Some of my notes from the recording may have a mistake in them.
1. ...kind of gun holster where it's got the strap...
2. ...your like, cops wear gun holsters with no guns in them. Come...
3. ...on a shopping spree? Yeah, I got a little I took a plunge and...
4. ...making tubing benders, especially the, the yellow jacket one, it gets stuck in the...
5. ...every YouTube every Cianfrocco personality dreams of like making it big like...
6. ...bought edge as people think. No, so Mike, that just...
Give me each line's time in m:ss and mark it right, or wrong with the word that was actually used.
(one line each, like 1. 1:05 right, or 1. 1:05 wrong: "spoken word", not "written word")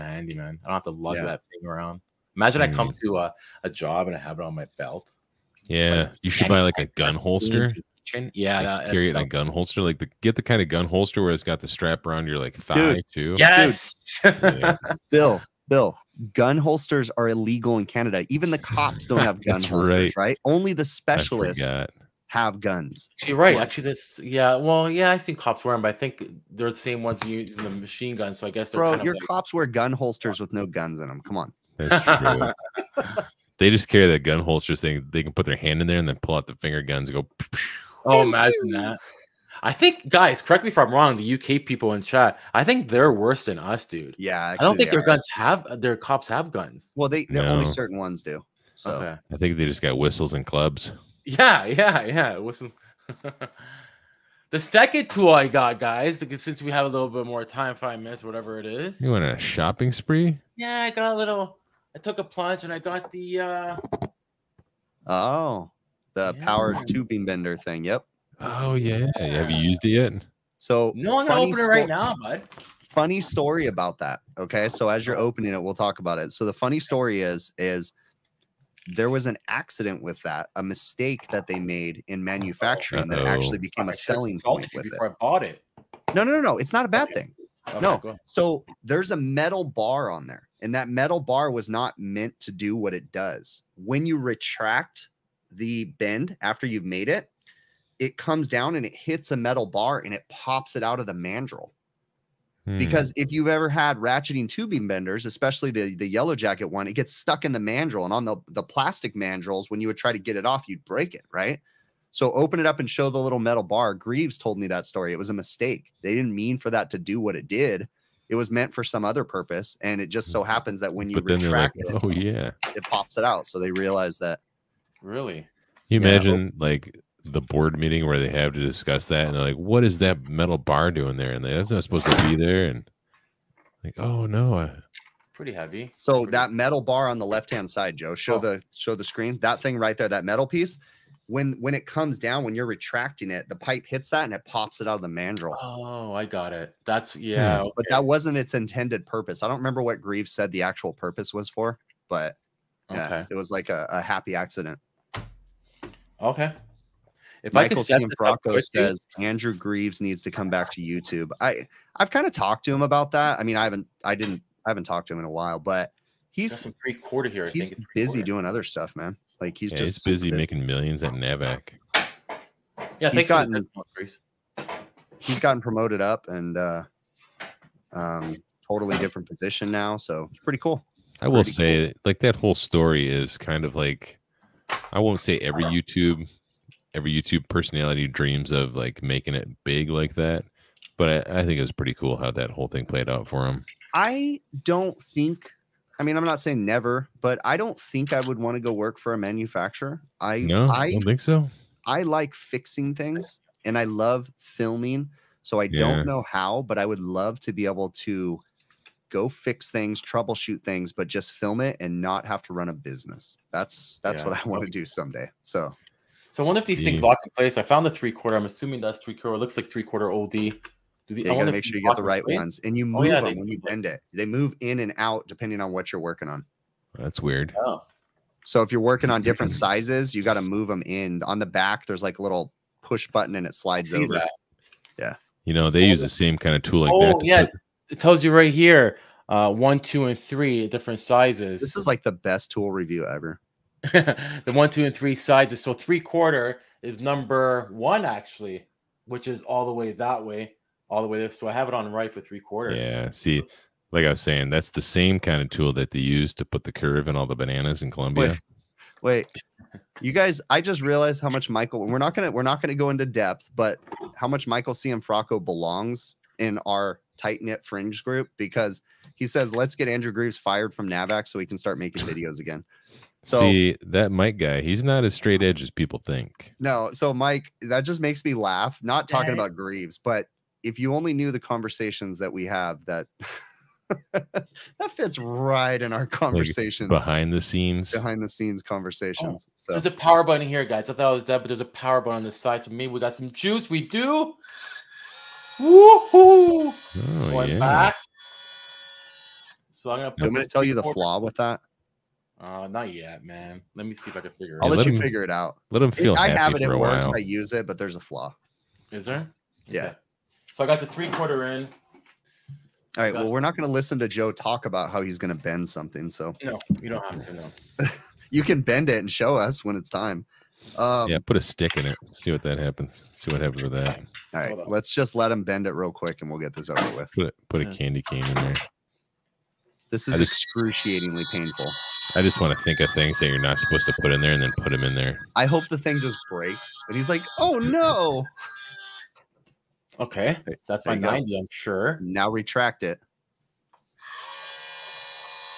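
1. 0:10 right
2. 0:29 right
3. 0:59 right
4. 1:43 wrong: "ratcheting", not "making"
5. 3:05 wrong: "YouTube", not "Cianfrocco"
6. 4:35 wrong: "straight", not "bought".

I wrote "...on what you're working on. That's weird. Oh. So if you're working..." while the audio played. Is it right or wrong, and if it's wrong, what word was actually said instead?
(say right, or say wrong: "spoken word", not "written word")
right.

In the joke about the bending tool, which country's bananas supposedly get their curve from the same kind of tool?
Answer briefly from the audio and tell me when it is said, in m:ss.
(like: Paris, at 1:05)
Colombia, at 4:17.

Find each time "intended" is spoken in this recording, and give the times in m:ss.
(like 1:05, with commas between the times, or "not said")
2:28.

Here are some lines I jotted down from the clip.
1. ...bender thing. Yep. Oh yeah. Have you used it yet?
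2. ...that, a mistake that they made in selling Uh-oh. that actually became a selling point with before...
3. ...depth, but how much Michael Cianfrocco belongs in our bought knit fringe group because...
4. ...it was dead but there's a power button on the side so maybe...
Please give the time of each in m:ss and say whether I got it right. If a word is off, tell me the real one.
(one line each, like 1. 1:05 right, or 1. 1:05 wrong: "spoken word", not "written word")
1. 1:07 right
2. 1:20 wrong: "manufacturing", not "selling"
3. 4:23 wrong: "tight", not "bought"
4. 4:51 right.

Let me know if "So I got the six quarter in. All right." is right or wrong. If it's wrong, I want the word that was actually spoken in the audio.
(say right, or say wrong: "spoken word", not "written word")
wrong: "three", not "six".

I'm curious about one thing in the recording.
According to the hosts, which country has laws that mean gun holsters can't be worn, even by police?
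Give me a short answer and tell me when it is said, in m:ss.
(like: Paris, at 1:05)
Canada, at 0:17.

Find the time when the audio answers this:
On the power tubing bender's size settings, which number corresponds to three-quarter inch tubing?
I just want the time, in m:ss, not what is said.
4:06.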